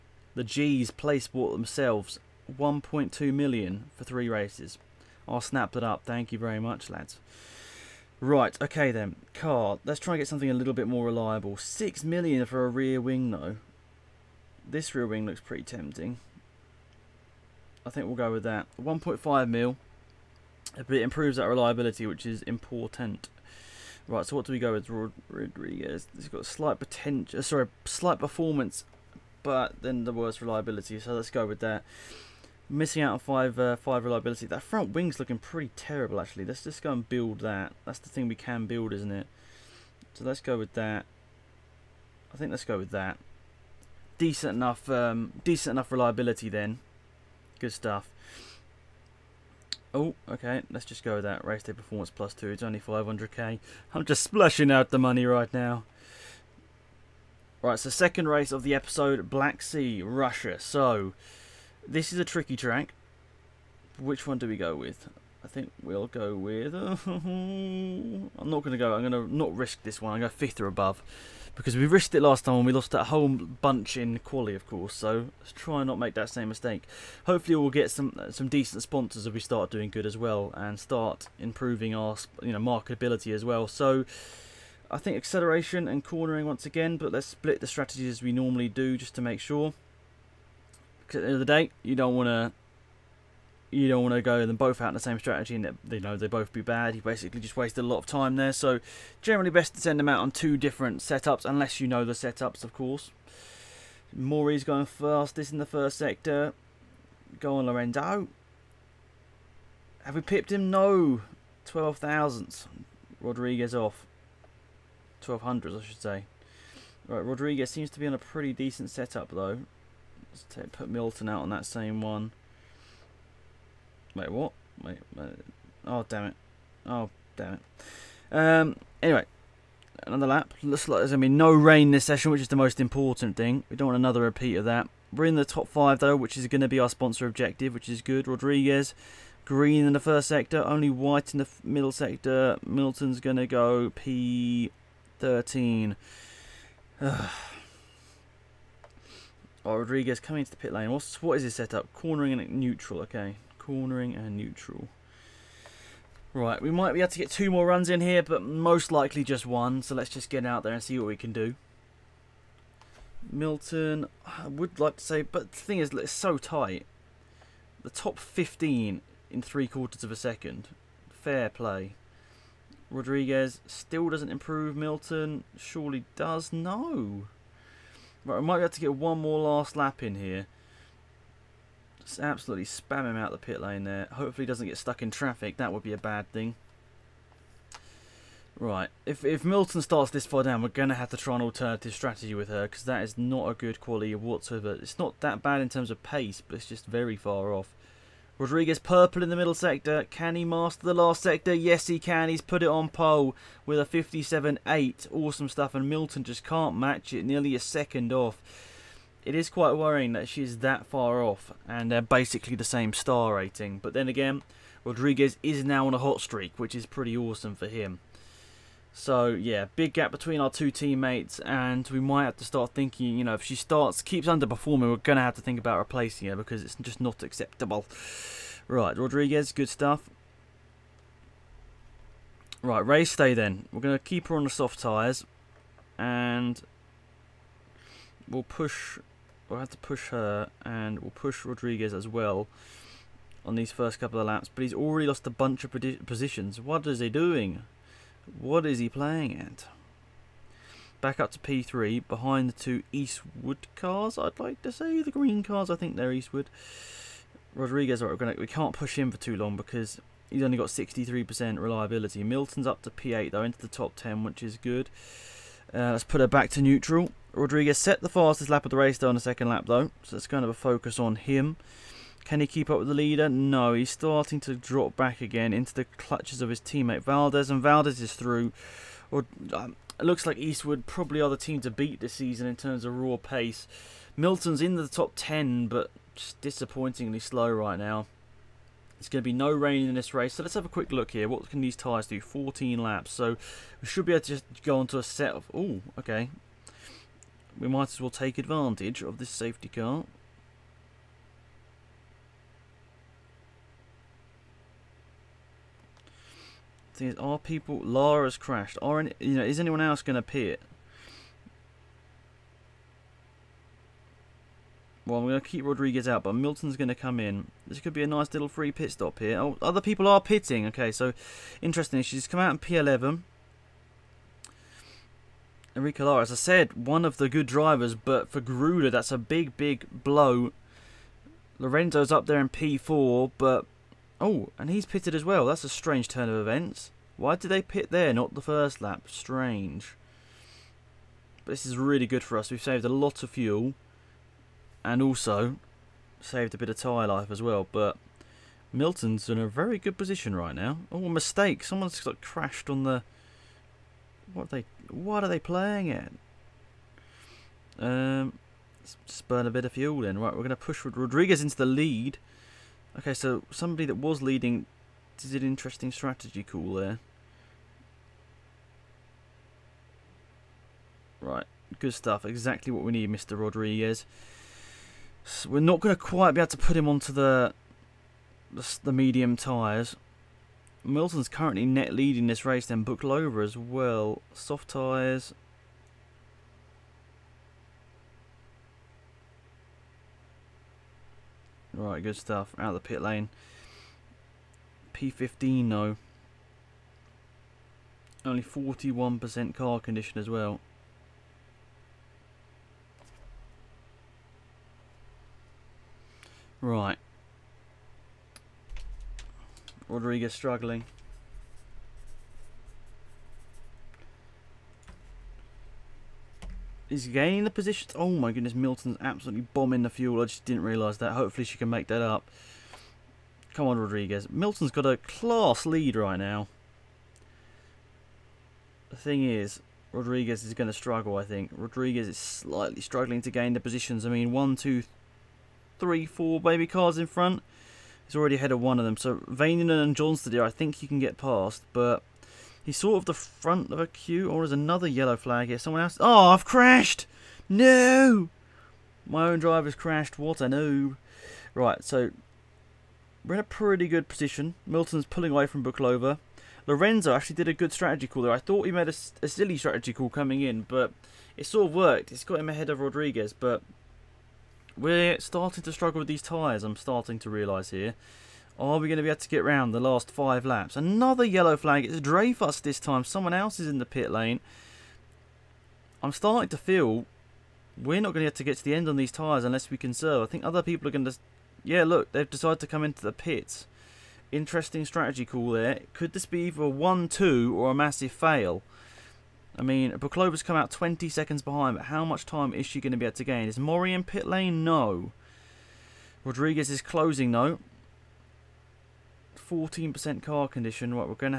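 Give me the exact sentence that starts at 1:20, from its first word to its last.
And start improving our you know marketability as well.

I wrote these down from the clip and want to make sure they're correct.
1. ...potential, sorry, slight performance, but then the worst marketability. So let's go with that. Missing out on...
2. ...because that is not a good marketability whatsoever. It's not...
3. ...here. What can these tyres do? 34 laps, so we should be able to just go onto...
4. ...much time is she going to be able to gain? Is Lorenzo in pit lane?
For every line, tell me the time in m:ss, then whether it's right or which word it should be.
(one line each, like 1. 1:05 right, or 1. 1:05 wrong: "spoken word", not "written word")
1. 0:26 wrong: "reliability", not "marketability"
2. 3:12 wrong: "quality", not "marketability"
3. 4:51 wrong: "14", not "34"
4. 8:12 wrong: "Mori", not "Lorenzo".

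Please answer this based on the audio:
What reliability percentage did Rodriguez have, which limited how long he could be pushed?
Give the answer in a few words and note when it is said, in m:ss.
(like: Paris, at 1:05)
63%, at 4:20.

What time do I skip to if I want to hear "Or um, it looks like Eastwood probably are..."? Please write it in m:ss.
4:39.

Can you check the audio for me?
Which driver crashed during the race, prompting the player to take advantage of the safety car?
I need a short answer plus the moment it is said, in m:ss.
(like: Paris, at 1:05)
Enrique Lara, at 5:25.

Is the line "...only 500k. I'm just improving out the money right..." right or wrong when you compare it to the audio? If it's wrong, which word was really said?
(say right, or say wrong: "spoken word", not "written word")
wrong: "splashing", not "improving".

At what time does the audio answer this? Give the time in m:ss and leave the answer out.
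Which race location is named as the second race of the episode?
0:59.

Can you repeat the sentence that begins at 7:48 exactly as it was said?
Are we going to be able to get round the last five laps?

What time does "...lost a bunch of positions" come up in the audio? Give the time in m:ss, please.
4:05.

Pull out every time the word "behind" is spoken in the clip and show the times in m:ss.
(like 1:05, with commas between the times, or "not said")
4:12, 8:11.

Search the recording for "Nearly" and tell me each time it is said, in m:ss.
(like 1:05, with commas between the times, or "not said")
3:27.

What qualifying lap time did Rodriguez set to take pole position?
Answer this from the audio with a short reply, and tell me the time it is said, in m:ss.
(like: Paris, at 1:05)
57.8, at 3:23.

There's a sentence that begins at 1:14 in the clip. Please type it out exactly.
So let's try and not make that same mistake.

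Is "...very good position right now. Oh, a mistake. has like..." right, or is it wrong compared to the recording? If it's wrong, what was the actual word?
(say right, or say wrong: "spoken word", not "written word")
right.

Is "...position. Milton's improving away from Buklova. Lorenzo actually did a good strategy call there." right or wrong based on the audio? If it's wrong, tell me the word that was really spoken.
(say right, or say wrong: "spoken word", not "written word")
wrong: "pulling", not "improving".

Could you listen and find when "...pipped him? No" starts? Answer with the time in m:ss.
1:50.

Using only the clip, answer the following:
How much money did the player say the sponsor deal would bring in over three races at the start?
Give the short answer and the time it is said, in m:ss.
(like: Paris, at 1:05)
1.2 million, at 0:02.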